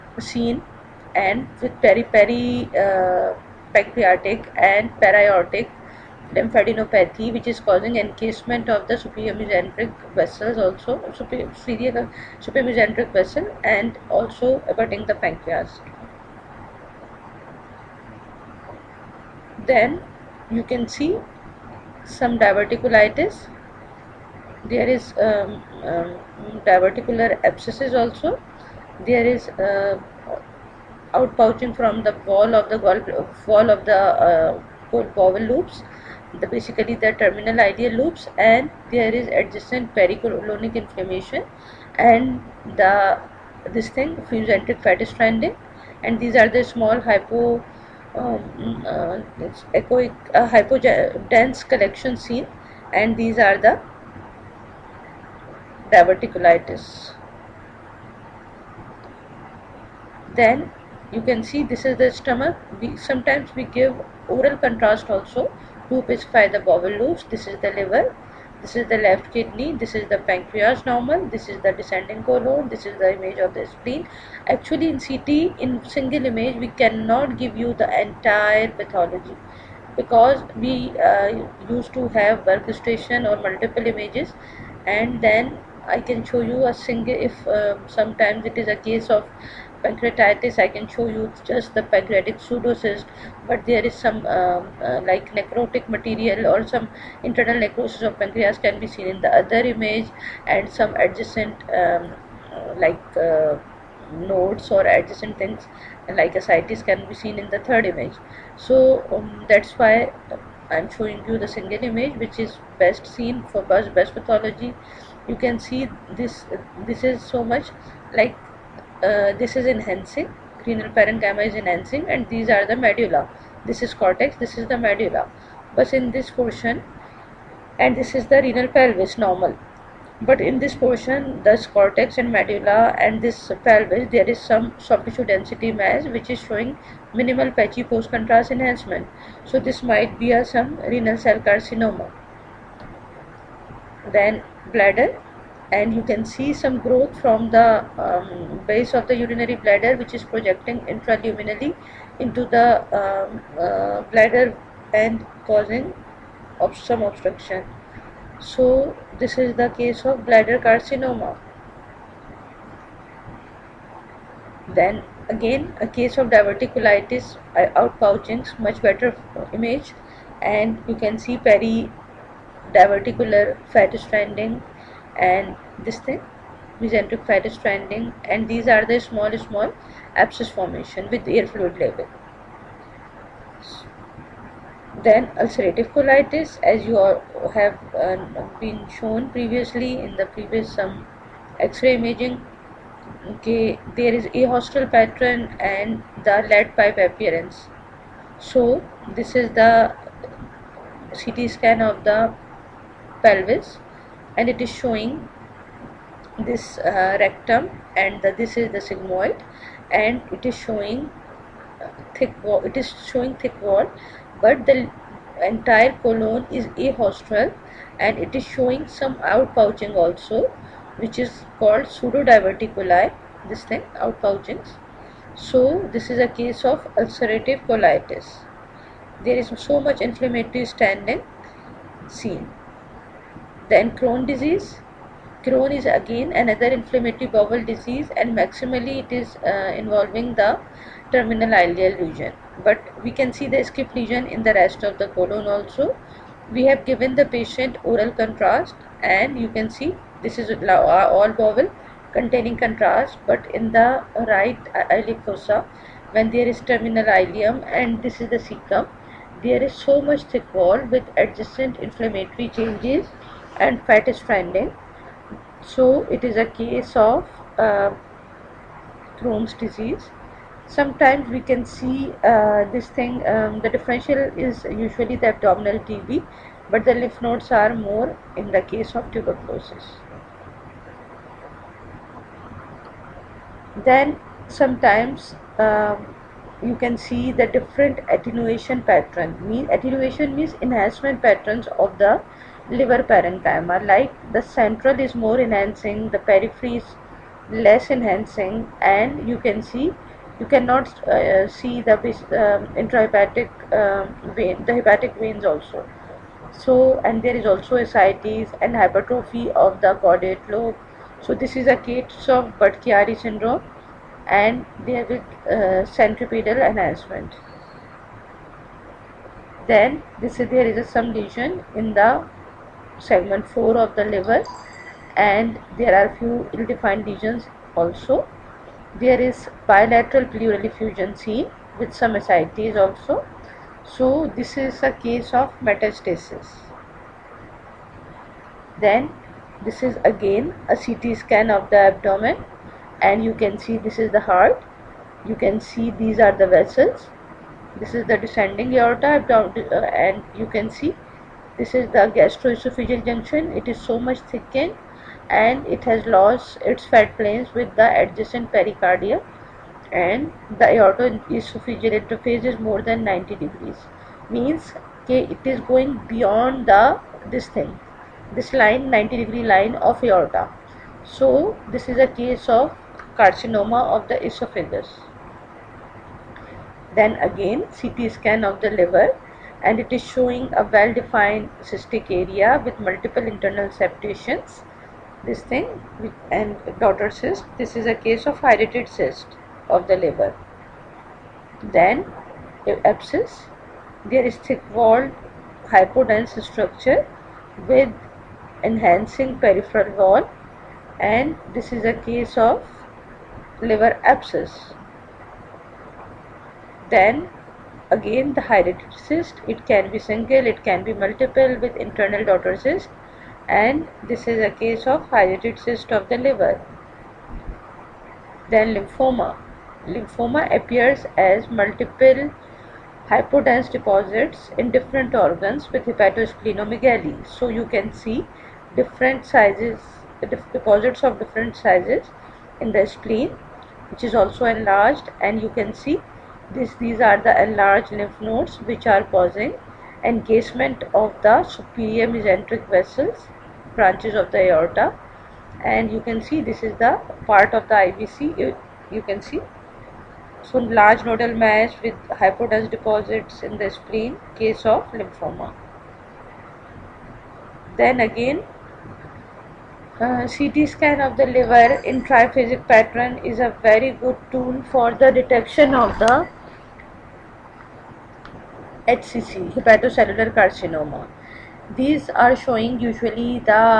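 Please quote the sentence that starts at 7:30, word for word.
So large nodal mass with hypodense deposits in the spleen, case of lymphoma.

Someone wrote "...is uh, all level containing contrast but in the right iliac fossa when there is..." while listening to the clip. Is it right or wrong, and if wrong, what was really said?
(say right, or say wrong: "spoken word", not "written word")
wrong: "bowel", not "level".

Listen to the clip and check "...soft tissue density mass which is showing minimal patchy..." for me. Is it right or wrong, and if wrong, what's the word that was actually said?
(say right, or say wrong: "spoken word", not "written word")
right.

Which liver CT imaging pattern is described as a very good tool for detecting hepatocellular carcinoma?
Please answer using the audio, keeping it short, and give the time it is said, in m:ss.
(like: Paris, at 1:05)
triphasic, at 7:42.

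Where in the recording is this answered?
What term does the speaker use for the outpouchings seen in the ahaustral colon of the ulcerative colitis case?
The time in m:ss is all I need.
3:41.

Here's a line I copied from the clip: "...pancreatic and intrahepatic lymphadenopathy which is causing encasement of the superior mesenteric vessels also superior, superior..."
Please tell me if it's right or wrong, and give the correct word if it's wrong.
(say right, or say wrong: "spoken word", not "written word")
wrong: "periaortic", not "intrahepatic".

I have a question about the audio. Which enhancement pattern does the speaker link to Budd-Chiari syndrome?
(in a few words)
centripetal enhancement.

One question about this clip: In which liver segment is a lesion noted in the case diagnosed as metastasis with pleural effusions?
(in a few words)
segment 4.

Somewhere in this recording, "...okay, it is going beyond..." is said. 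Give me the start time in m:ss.
6:05.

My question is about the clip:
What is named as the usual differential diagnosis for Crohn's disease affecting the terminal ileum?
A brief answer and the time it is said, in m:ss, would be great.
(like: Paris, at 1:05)
abdominal TB, at 4:35.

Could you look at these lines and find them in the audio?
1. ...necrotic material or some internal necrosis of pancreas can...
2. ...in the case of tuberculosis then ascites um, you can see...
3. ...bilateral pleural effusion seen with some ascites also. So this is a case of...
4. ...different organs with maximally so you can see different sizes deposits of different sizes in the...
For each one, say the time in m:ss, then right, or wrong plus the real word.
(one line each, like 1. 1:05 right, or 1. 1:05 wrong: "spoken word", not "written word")
1. 1:35 right
2. 4:38 wrong: "sometimes", not "ascites"
3. 5:29 right
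4. 7:04 wrong: "hepatosplenomegaly", not "maximally".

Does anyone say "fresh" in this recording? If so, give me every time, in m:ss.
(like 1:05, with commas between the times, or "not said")
not said.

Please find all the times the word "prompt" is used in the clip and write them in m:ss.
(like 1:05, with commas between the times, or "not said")
not said.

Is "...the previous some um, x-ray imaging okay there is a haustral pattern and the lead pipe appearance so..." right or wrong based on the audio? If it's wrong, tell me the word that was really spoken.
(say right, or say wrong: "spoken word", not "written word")
right.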